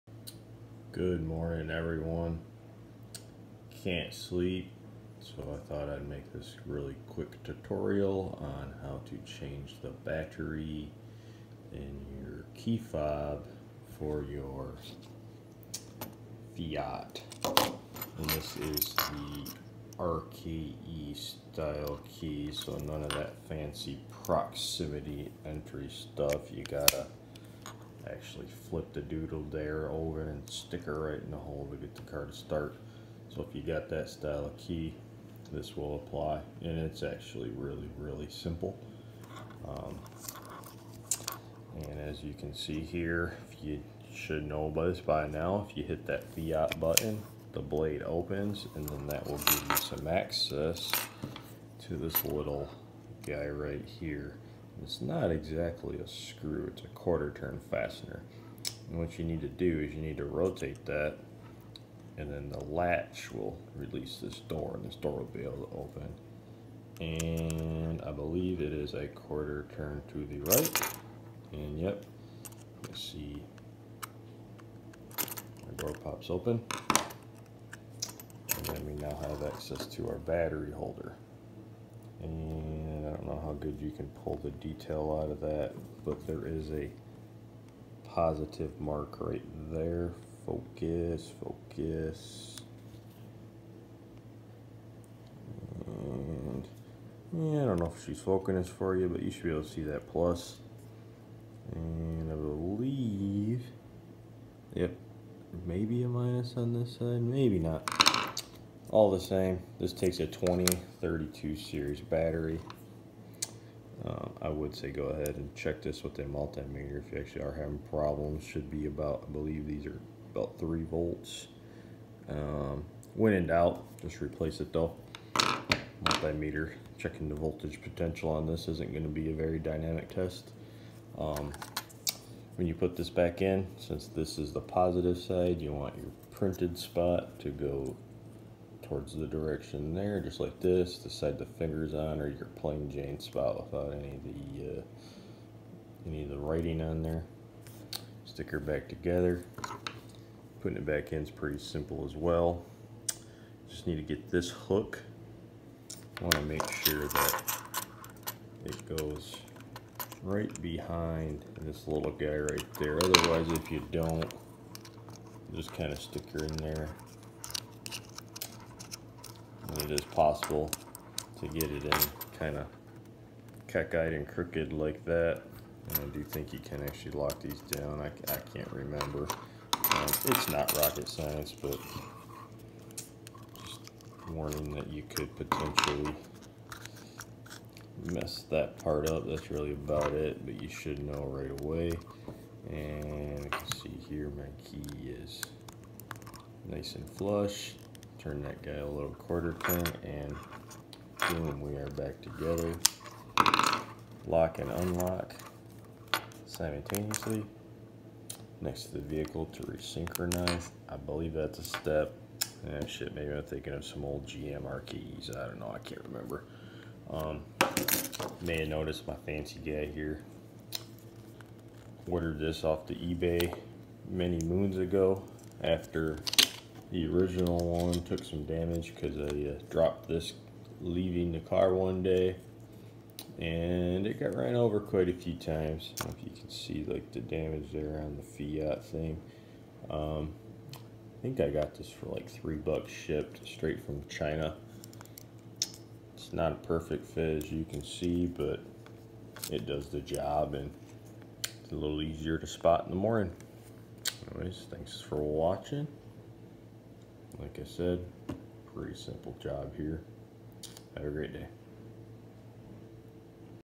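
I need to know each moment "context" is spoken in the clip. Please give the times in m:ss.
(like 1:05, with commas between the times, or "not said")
not said.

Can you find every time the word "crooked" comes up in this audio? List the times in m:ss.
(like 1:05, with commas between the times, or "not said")
2:54.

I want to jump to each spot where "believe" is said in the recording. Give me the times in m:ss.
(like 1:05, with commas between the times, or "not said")
1:08, 1:42, 1:59, 3:30.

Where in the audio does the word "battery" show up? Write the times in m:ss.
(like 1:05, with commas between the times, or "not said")
0:09, 1:20, 1:51.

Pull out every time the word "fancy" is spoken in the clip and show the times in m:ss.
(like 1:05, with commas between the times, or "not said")
0:23, 3:39.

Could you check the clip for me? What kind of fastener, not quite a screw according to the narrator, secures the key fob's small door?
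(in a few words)
quarter turn fastener.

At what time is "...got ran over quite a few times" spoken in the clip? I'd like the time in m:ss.
3:54.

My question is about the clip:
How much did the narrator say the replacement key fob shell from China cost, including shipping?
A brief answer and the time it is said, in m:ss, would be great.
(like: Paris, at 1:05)
3 dollars, at 4:02.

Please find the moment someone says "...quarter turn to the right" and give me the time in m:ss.
1:09.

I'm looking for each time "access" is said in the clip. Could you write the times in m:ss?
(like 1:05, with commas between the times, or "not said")
0:50, 1:19.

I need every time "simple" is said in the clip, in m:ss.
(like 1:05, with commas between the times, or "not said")
0:38, 2:31, 4:18.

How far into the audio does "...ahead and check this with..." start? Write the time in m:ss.
1:55.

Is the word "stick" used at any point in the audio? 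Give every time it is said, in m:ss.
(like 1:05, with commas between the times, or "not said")
0:30, 2:28, 2:46.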